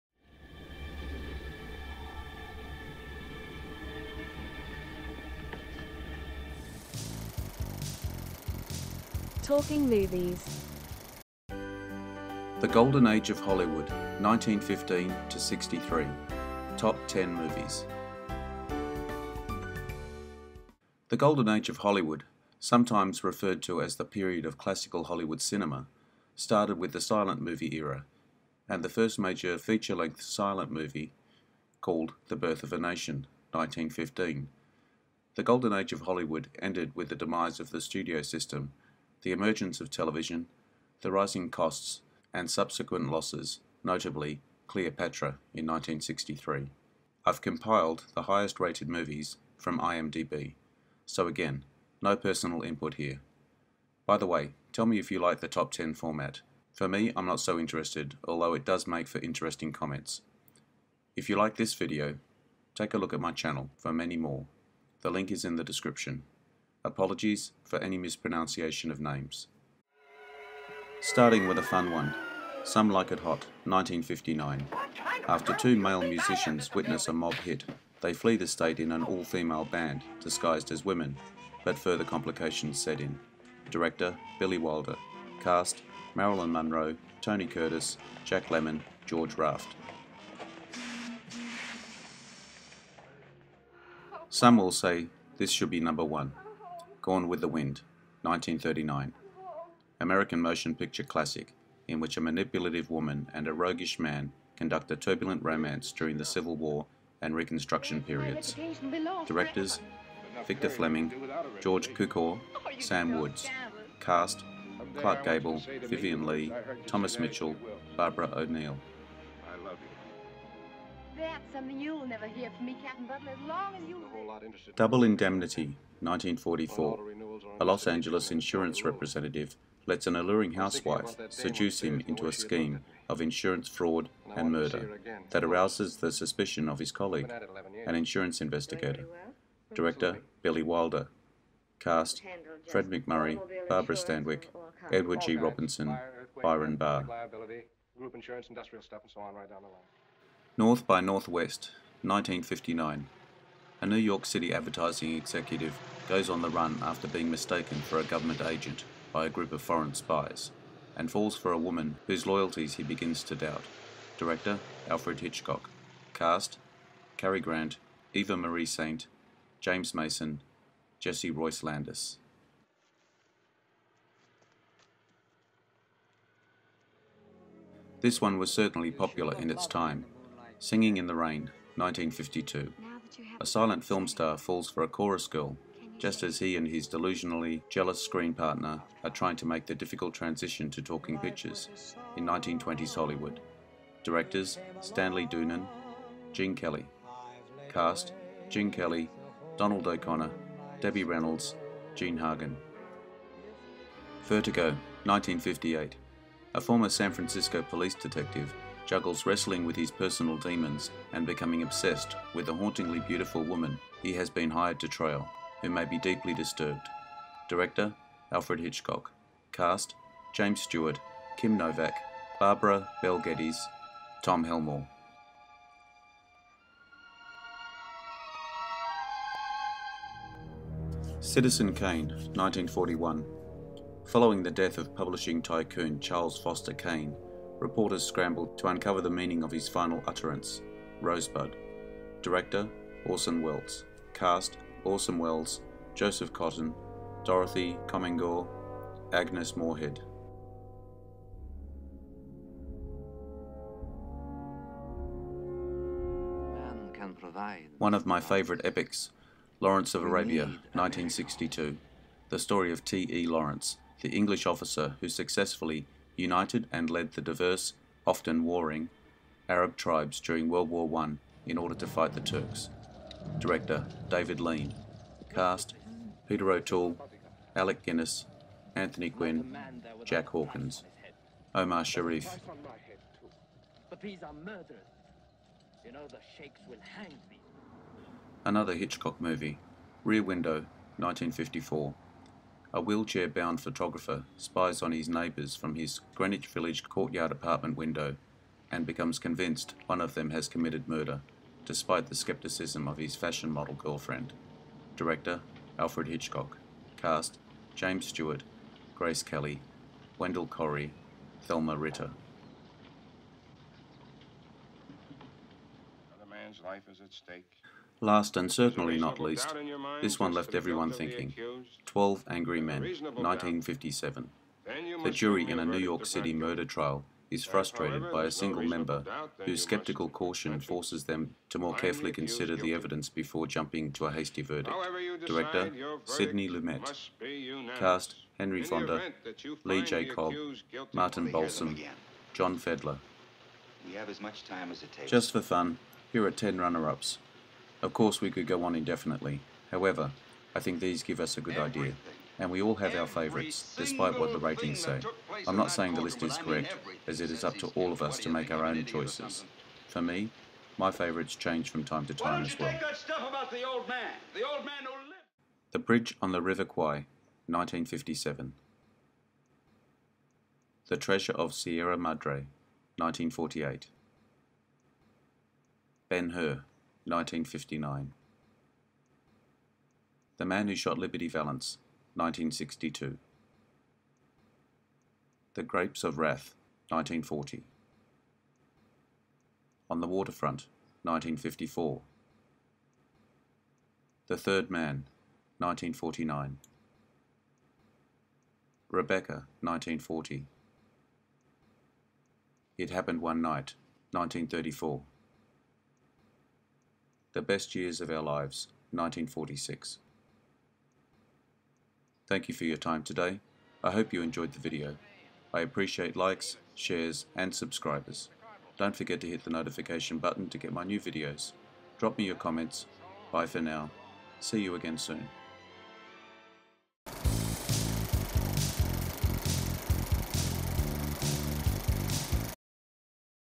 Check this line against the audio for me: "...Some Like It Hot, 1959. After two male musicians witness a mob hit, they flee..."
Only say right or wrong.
right.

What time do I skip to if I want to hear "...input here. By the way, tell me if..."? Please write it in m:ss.
0:52.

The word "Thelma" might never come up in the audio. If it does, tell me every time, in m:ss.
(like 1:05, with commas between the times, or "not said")
5:11.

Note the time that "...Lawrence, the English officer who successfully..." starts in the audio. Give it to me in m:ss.
4:23.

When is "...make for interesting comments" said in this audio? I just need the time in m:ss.
0:58.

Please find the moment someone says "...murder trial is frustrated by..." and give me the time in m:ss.
5:26.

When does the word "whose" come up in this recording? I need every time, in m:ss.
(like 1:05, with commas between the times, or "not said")
2:42, 5:29.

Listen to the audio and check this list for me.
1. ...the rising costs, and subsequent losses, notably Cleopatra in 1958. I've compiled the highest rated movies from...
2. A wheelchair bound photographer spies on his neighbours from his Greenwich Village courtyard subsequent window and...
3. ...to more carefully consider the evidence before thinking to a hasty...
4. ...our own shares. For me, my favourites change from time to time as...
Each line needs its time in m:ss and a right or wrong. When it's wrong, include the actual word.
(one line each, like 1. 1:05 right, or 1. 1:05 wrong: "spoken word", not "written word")
1. 0:41 wrong: "1963", not "1958"
2. 4:52 wrong: "apartment", not "subsequent"
3. 5:31 wrong: "jumping", not "thinking"
4. 5:58 wrong: "choices", not "shares".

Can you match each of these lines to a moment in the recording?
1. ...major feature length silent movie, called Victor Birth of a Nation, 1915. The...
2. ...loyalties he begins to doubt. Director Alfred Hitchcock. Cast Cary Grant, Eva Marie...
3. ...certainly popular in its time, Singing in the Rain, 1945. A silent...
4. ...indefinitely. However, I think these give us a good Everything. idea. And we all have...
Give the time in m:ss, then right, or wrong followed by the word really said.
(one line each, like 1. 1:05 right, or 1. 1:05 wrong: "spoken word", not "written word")
1. 0:29 wrong: "The", not "Victor"
2. 2:42 right
3. 2:58 wrong: "1952", not "1945"
4. 5:48 right.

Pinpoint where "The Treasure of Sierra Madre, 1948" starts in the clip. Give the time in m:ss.
6:10.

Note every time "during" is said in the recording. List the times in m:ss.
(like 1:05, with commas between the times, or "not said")
1:45, 4:30.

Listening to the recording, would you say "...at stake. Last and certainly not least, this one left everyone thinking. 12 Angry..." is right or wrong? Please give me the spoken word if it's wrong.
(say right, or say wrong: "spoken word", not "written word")
right.